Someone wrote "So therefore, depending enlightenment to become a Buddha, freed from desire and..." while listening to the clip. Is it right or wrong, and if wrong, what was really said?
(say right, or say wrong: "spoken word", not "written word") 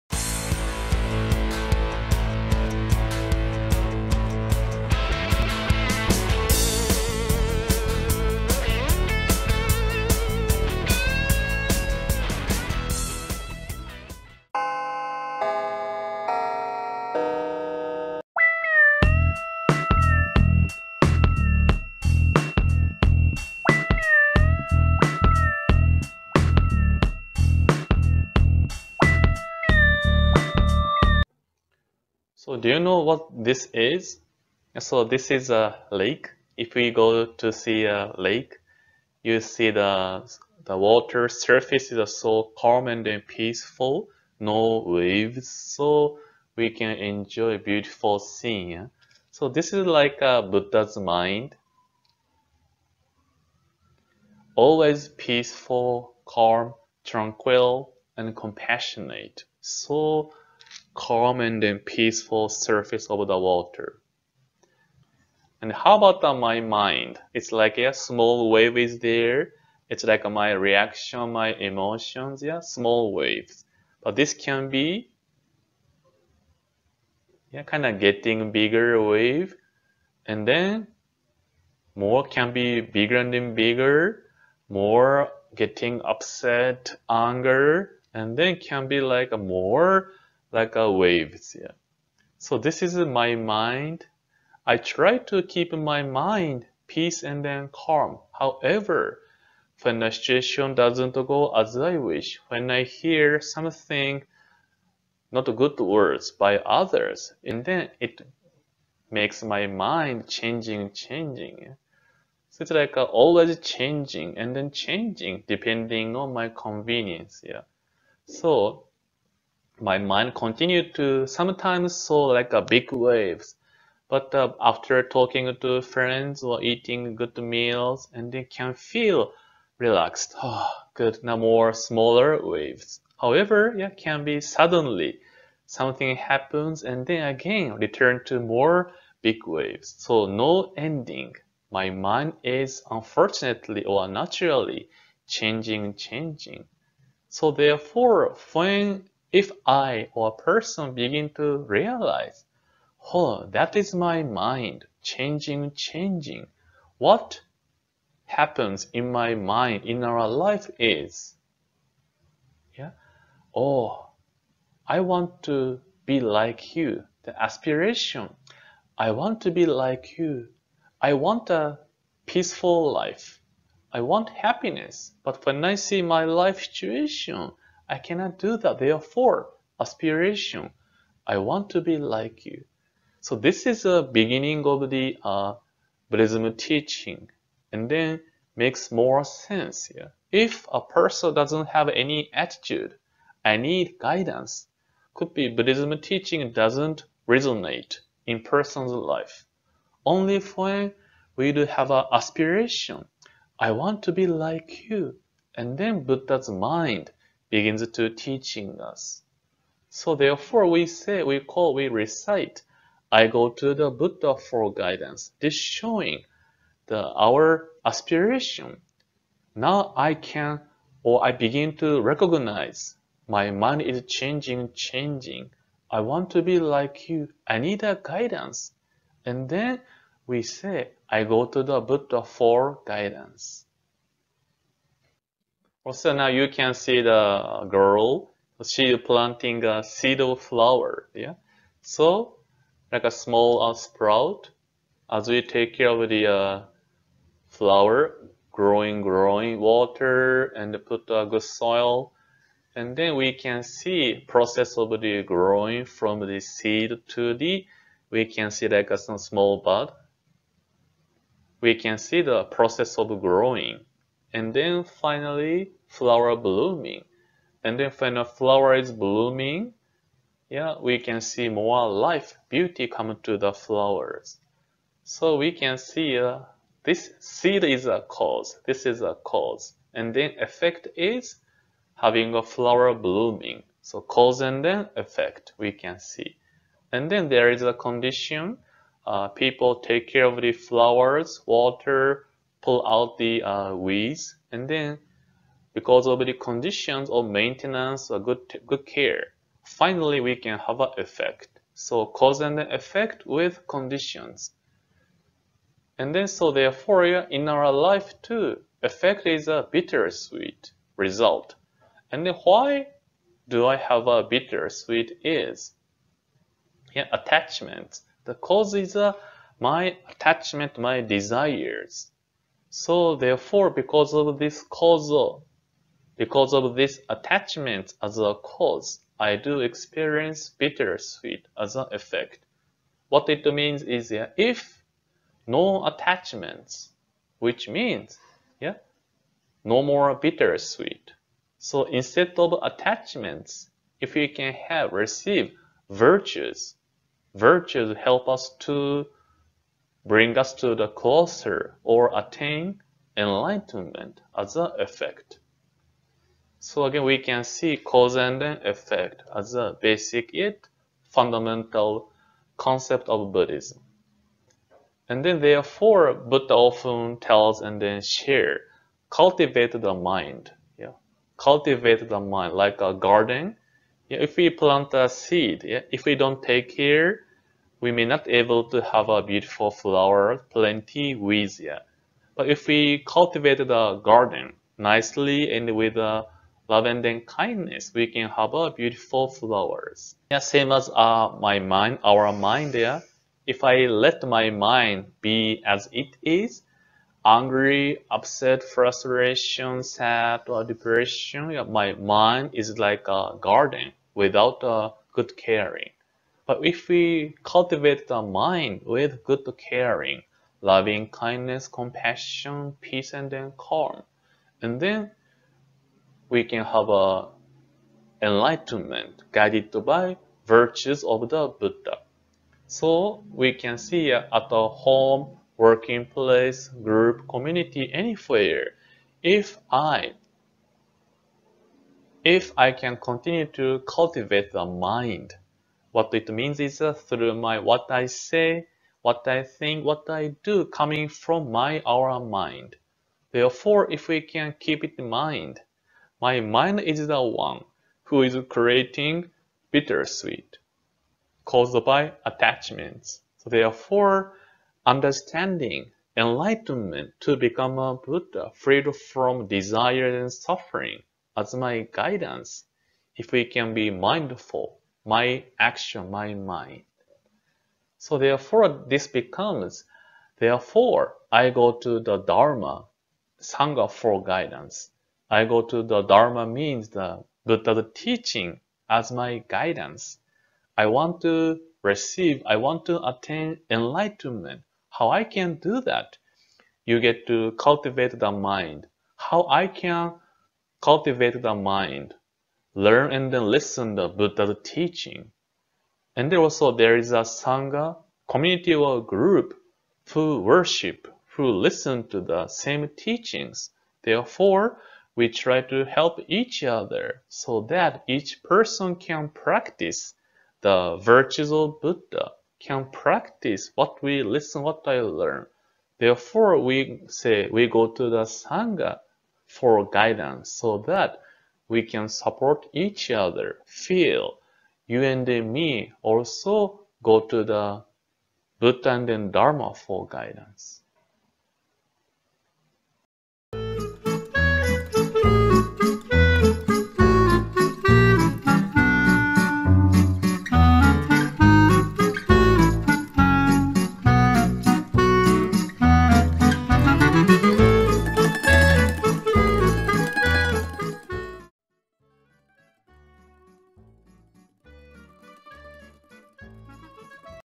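wrong: "understanding", not "depending".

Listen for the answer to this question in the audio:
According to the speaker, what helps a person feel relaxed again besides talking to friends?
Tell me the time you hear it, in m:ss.
2:06.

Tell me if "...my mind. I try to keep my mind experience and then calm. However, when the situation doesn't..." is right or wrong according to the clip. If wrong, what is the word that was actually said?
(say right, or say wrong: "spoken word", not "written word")
wrong: "peace", not "experience".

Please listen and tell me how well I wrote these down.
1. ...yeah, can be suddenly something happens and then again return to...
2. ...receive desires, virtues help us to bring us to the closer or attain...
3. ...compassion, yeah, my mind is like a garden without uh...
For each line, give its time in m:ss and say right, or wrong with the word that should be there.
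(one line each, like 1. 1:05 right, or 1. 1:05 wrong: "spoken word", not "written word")
1. 2:13 right
2. 5:44 wrong: "virtues", not "desires"
3. 6:40 wrong: "depression", not "compassion".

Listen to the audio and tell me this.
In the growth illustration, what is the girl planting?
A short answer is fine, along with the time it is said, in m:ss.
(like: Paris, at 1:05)
A seed of flower, at 3:59.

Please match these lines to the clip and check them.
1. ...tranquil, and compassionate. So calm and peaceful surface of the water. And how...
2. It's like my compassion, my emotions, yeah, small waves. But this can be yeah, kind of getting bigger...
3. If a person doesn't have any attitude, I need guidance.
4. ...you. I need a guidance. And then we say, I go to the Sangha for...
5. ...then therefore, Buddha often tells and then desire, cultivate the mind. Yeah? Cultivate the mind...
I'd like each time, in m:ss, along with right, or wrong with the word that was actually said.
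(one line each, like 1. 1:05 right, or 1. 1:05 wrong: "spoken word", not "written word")
1. 0:57 right
2. 1:09 wrong: "reaction", not "compassion"
3. 3:10 right
4. 3:47 wrong: "Buddha", not "Sangha"
5. 6:05 wrong: "share", not "desire".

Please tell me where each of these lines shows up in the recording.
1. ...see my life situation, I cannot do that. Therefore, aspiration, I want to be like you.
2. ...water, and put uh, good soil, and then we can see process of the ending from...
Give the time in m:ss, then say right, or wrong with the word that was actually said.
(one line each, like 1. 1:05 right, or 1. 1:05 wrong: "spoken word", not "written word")
1. 2:55 right
2. 4:09 wrong: "growing", not "ending".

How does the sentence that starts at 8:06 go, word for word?
You get to cultivate the mind.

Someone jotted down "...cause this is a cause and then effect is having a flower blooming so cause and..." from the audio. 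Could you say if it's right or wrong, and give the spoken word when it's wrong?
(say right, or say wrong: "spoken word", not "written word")
right.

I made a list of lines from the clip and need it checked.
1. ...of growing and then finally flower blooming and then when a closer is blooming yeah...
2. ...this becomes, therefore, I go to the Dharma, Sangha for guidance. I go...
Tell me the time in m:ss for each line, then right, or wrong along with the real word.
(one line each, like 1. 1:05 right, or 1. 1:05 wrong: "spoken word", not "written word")
1. 4:22 wrong: "flower", not "closer"
2. 7:48 right.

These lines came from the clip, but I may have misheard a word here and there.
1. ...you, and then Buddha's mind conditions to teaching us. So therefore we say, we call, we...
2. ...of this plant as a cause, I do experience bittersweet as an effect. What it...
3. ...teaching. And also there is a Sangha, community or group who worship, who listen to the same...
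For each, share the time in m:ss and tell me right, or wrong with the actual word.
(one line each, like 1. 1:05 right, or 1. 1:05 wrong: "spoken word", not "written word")
1. 3:24 wrong: "begins", not "conditions"
2. 5:26 wrong: "attachment", not "plant"
3. 8:14 right.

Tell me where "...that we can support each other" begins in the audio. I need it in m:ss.
8:40.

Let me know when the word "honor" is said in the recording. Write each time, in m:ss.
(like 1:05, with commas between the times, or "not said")
not said.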